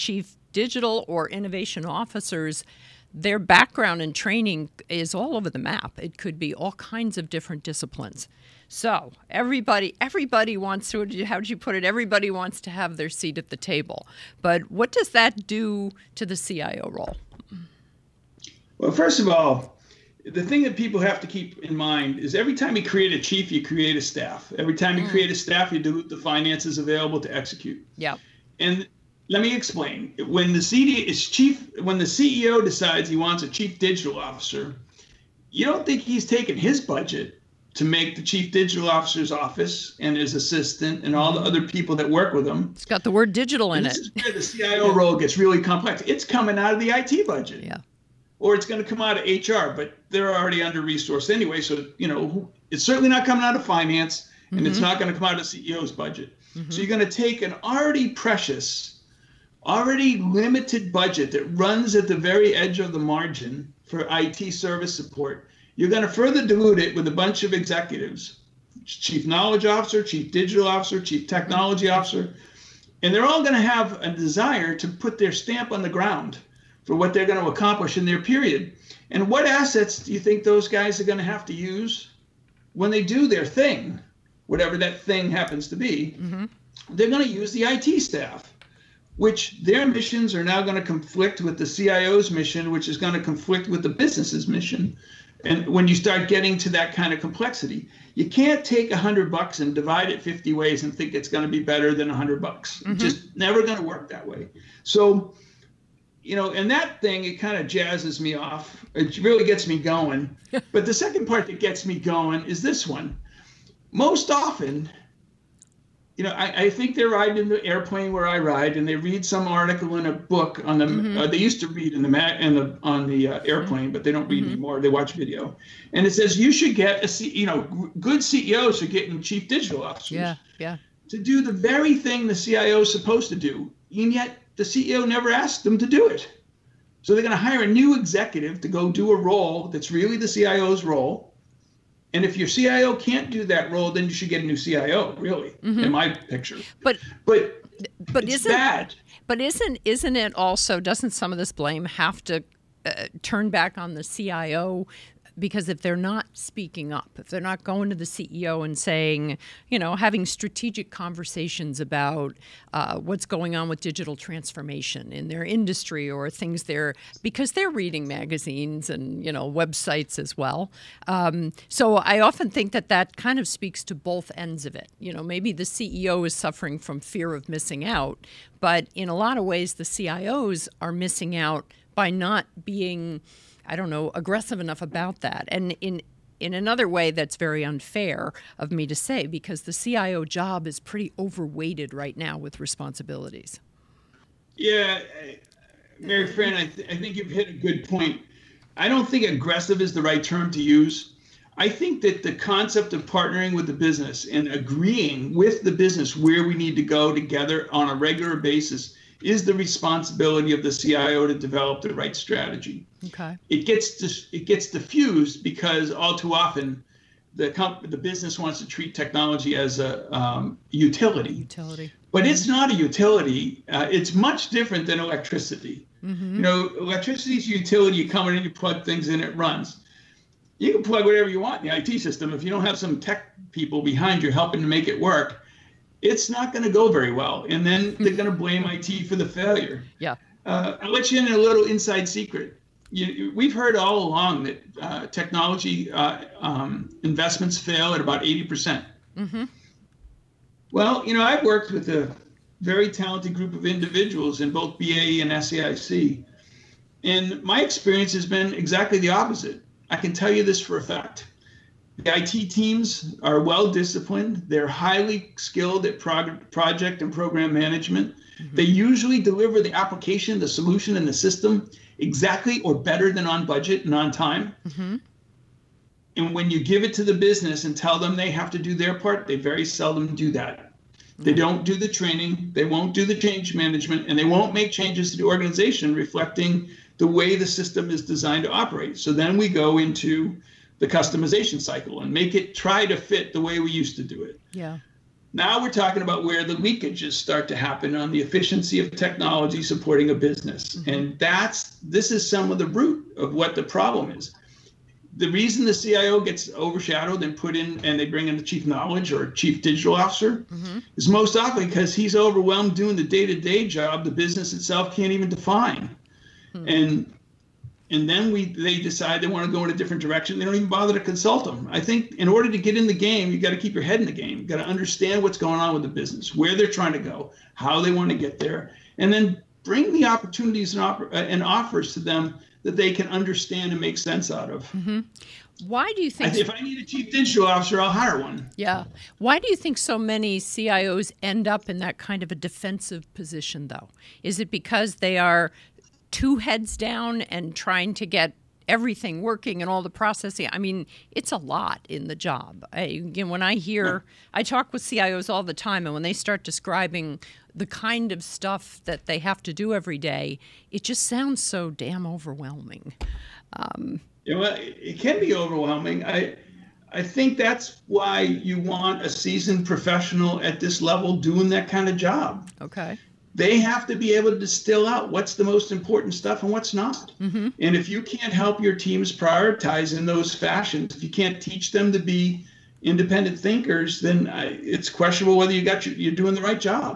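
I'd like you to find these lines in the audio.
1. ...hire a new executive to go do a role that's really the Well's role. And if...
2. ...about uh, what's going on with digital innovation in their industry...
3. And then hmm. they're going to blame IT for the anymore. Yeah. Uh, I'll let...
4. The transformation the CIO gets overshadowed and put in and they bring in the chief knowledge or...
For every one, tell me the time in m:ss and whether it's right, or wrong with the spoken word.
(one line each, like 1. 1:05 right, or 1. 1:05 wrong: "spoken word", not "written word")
1. 2:17 wrong: "CIO", not "Well"
2. 2:41 wrong: "transformation", not "innovation"
3. 3:57 wrong: "failure", not "anymore"
4. 5:05 wrong: "reason", not "transformation".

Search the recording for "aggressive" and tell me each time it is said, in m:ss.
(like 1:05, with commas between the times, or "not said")
3:04, 3:19.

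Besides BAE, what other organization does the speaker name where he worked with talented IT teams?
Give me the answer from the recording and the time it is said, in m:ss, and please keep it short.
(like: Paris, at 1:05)
SAIC, at 4:15.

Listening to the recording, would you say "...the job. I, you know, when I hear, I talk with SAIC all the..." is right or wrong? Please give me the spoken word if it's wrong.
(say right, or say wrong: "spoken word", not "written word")
wrong: "CIOs", not "SAIC".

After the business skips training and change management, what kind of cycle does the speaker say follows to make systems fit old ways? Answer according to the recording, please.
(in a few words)
Customization cycle.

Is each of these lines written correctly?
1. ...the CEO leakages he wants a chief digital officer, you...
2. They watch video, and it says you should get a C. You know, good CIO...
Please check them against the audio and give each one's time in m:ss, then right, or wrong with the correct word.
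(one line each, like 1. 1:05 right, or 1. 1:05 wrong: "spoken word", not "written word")
1. 0:31 wrong: "decides", not "leakages"
2. 2:04 wrong: "CEOs", not "CIO".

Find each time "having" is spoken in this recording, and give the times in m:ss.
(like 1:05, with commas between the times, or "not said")
2:39.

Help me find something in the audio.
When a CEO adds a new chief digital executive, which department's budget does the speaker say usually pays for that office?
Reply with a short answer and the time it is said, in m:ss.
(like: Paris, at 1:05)
IT budget, at 0:46.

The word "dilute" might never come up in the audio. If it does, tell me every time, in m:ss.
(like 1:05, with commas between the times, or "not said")
0:25, 1:06.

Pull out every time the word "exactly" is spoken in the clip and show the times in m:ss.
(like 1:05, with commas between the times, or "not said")
4:18, 4:31.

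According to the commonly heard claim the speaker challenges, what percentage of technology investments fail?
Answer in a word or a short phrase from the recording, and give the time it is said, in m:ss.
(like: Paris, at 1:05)
80%, at 4:08.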